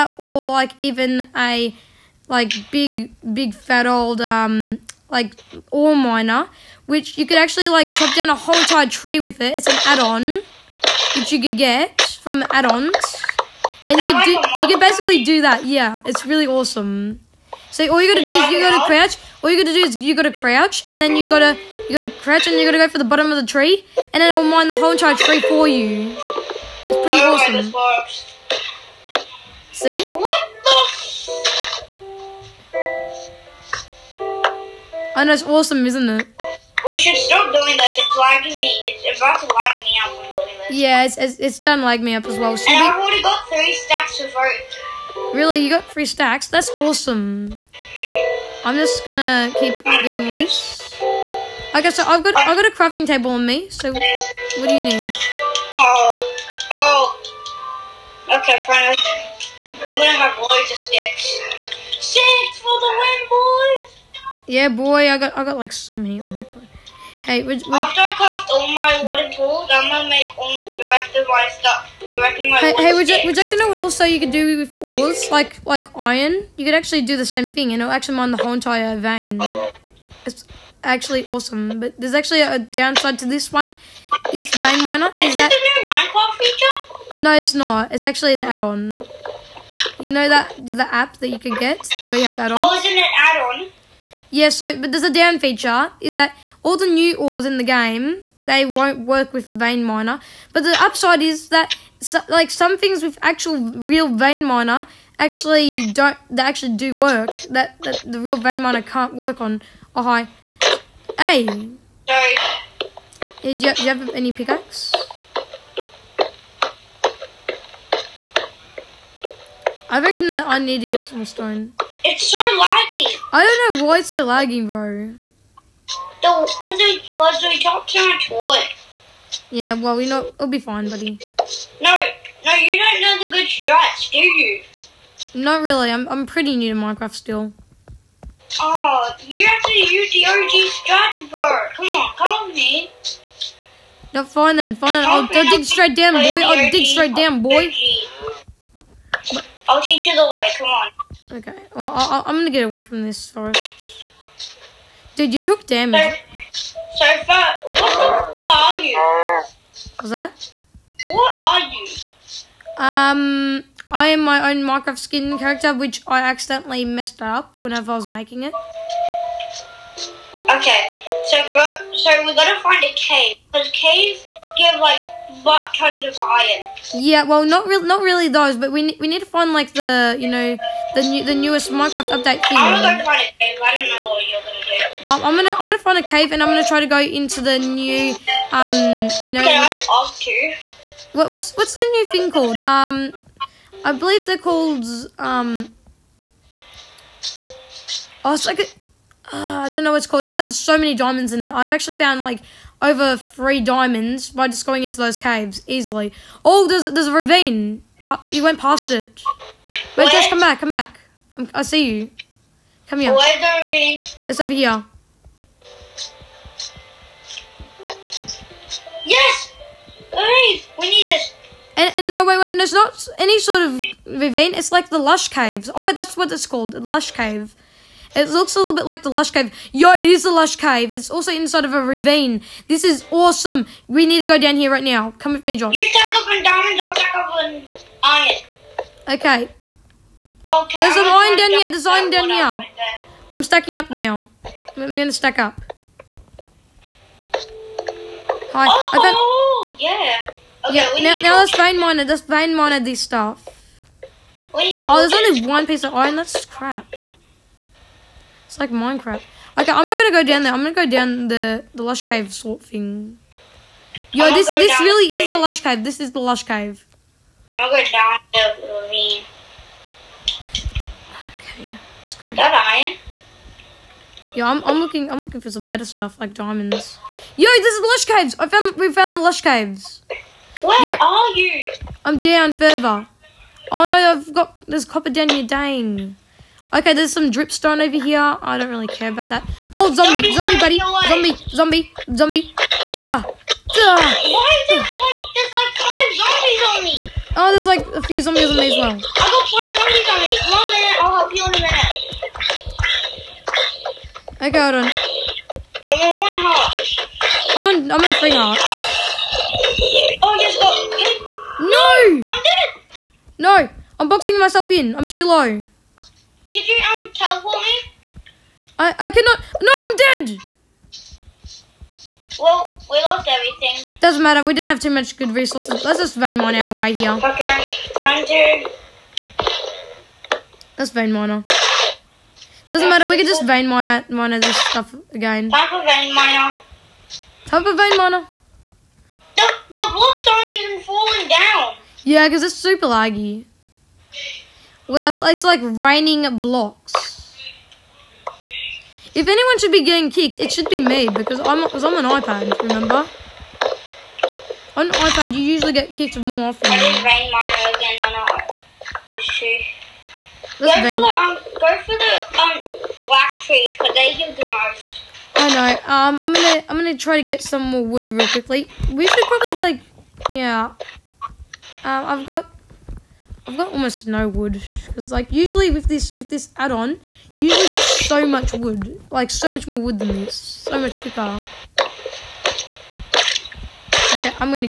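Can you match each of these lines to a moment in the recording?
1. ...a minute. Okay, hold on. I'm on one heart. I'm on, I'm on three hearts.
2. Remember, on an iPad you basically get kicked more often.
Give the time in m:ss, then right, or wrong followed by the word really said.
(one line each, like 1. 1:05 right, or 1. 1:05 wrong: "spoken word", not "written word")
1. 5:04 right
2. 5:52 wrong: "usually", not "basically".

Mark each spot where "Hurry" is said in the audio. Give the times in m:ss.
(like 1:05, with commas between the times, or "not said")
3:40.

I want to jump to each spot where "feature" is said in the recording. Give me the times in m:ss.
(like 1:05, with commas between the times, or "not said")
1:26, 1:35.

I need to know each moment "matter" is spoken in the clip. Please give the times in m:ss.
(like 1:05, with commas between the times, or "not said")
5:24, 5:32.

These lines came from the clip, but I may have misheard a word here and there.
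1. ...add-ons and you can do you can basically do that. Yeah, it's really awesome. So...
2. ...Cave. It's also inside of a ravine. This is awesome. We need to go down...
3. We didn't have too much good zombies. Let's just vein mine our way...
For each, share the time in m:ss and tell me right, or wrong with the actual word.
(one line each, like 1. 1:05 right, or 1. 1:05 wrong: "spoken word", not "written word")
1. 0:12 right
2. 3:50 right
3. 5:24 wrong: "resources", not "zombies".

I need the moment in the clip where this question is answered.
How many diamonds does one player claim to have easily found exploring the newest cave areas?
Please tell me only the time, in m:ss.
3:22.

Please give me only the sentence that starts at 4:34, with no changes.
Yo, I'm I'm looking I'm looking for some better stuff like diamonds.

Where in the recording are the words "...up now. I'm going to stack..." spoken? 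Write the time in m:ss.
4:03.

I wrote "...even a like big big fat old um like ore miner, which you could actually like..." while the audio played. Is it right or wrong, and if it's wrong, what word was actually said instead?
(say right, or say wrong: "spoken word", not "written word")
right.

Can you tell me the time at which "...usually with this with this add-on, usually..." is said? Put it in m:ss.
6:15.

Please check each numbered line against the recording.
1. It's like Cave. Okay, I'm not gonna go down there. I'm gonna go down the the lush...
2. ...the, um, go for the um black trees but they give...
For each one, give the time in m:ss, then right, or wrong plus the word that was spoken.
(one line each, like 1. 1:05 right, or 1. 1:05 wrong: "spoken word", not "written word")
1. 4:18 wrong: "Minecraft", not "Cave"
2. 6:00 right.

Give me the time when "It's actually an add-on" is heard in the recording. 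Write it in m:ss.
1:27.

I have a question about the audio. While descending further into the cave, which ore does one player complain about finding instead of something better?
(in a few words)
Copper.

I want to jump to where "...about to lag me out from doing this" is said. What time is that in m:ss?
0:39.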